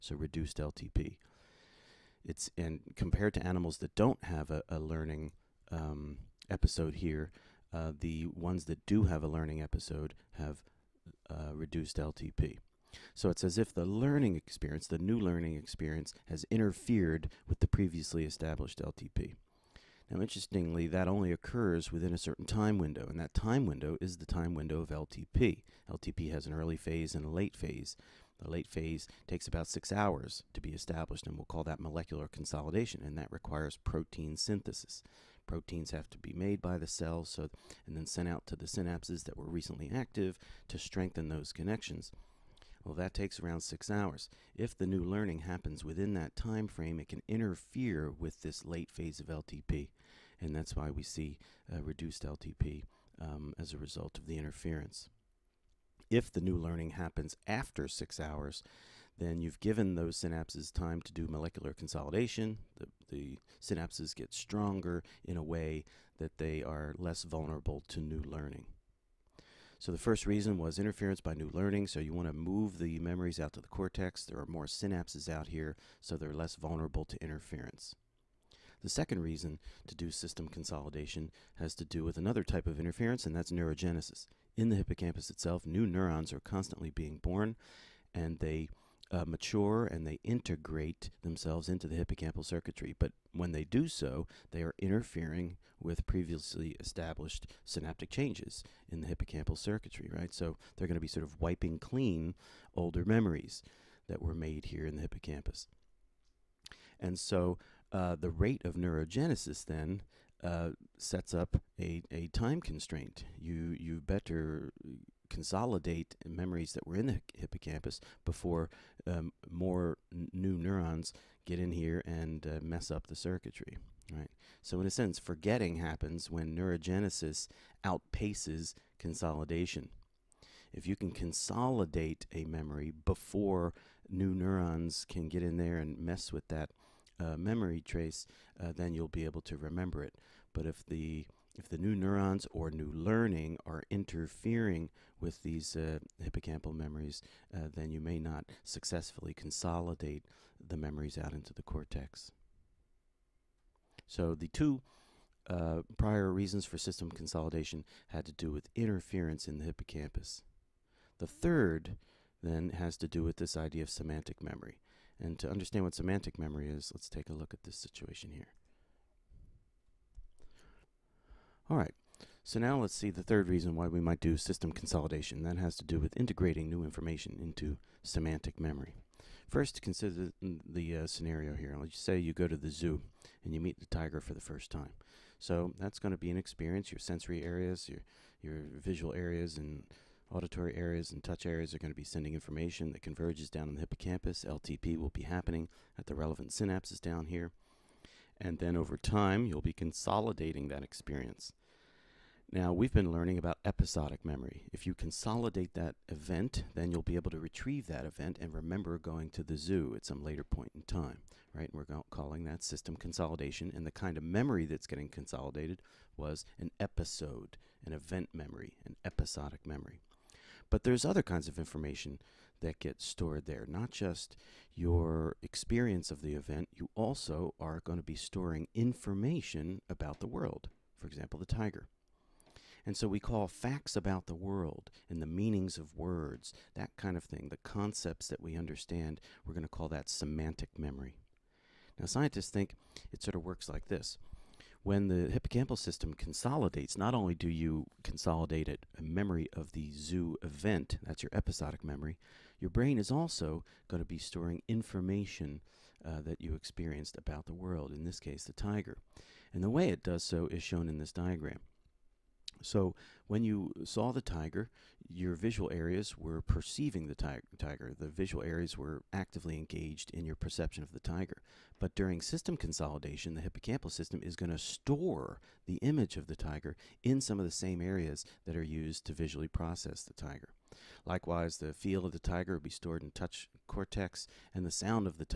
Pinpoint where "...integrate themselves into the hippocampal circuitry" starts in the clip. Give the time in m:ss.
1:30.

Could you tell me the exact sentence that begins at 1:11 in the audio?
So you want to move the memories out to the cortex.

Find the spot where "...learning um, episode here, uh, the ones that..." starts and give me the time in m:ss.
0:04.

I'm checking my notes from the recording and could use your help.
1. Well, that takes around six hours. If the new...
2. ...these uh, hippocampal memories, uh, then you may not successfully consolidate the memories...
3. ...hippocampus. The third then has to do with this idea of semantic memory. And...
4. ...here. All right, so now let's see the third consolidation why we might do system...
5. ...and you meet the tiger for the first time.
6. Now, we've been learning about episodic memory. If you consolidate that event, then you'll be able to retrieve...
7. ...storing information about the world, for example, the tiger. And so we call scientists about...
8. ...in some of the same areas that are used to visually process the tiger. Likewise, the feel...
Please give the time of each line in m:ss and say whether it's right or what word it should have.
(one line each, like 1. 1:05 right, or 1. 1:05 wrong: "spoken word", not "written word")
1. 0:42 right
2. 2:25 right
3. 2:39 right
4. 2:48 wrong: "reason", not "consolidation"
5. 3:03 right
6. 3:22 right
7. 3:48 wrong: "facts", not "scientists"
8. 4:37 right.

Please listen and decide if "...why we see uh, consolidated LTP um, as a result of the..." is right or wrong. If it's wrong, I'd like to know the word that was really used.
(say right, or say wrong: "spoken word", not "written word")
wrong: "reduced", not "consolidated".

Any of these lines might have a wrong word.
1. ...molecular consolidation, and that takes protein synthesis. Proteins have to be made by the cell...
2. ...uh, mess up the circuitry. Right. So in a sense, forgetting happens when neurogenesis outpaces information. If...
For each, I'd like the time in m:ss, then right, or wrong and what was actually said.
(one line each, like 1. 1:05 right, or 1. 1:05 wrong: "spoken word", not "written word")
1. 0:31 wrong: "requires", not "takes"
2. 2:02 wrong: "consolidation", not "information".